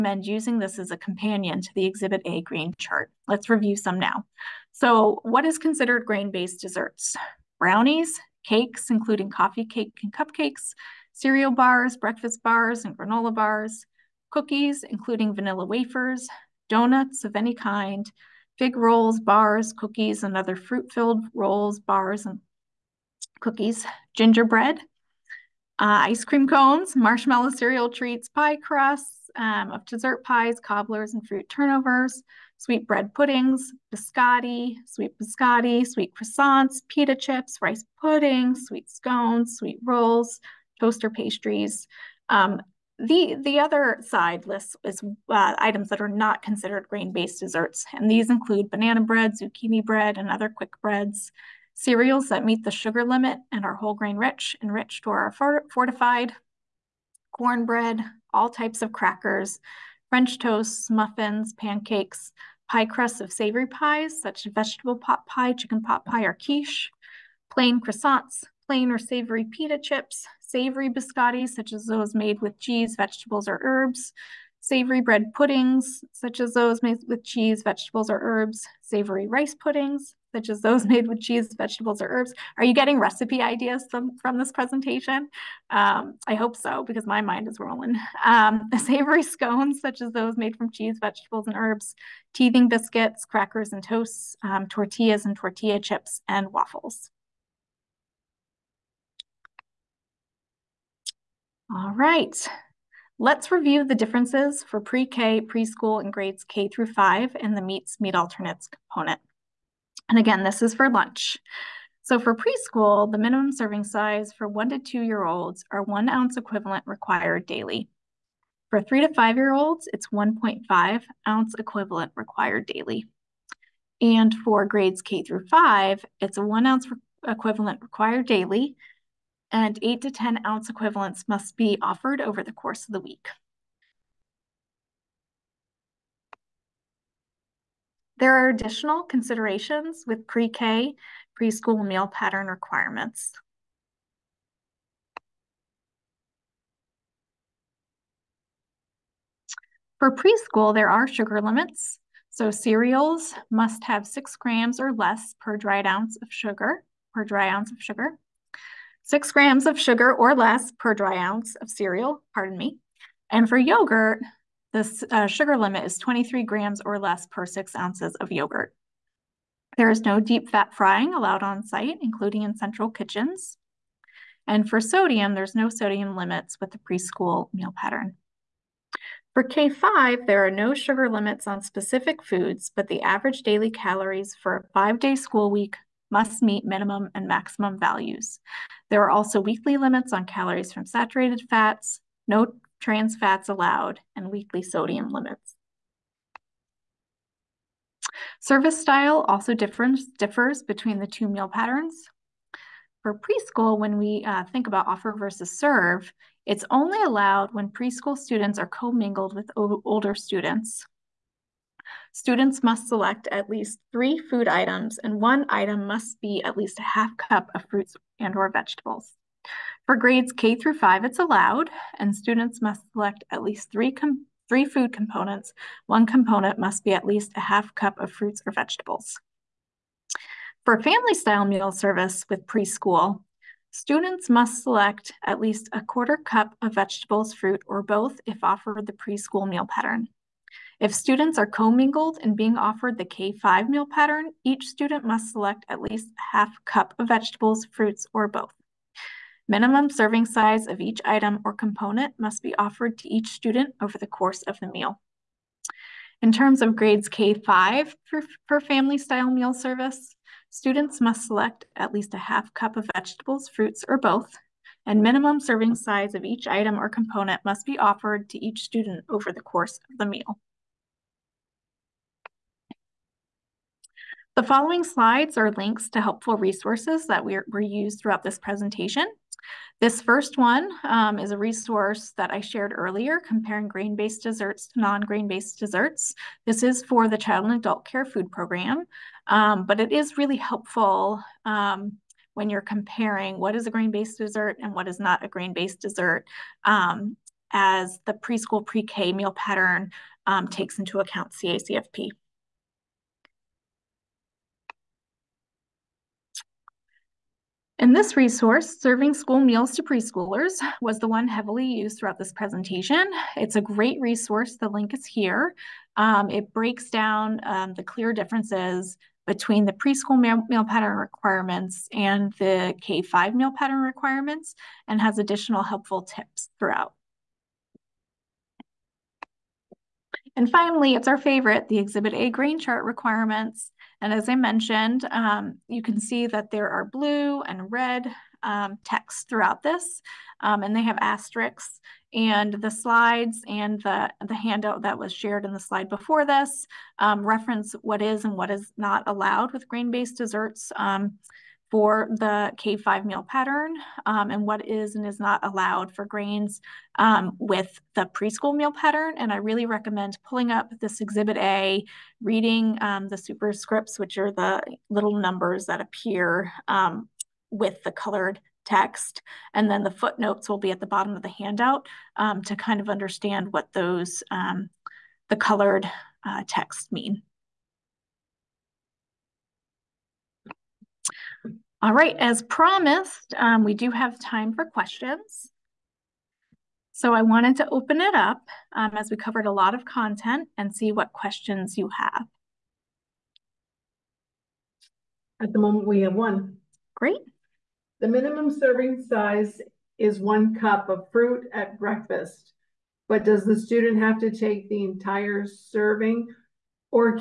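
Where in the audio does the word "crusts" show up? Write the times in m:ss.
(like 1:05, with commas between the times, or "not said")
0:28, 1:02.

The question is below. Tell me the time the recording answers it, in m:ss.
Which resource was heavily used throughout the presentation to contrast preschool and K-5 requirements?
5:08.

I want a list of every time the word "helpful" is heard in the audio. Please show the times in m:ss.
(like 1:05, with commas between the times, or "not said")
4:36, 4:50, 5:25.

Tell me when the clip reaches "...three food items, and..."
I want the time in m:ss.
3:33.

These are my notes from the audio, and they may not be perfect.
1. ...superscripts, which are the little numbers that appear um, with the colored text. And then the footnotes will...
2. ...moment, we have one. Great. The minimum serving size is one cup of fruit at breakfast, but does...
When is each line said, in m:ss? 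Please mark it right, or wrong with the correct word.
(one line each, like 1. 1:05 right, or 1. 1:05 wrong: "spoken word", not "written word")
1. 6:03 right
2. 6:35 right.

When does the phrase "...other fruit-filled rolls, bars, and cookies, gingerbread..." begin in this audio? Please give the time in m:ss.
0:20.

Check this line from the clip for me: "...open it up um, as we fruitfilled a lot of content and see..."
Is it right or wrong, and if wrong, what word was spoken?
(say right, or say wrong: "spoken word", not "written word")
wrong: "covered", not "fruitfilled".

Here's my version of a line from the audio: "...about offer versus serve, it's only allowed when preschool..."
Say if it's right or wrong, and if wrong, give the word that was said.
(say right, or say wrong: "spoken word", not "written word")
right.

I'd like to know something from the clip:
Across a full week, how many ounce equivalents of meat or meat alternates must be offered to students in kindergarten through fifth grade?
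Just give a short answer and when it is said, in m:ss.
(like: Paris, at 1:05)
8 to 10, at 2:09.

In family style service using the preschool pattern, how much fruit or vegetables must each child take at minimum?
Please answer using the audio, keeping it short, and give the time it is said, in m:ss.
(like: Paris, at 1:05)
a quarter cup, at 3:55.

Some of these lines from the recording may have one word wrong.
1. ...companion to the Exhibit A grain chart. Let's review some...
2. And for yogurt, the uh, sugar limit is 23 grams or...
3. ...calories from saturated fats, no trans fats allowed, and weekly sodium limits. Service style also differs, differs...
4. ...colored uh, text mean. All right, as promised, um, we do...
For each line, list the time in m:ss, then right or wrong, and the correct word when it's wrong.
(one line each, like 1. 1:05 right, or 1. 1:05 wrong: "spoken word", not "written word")
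1. 0:00 right
2. 2:43 right
3. 3:10 right
4. 6:15 right.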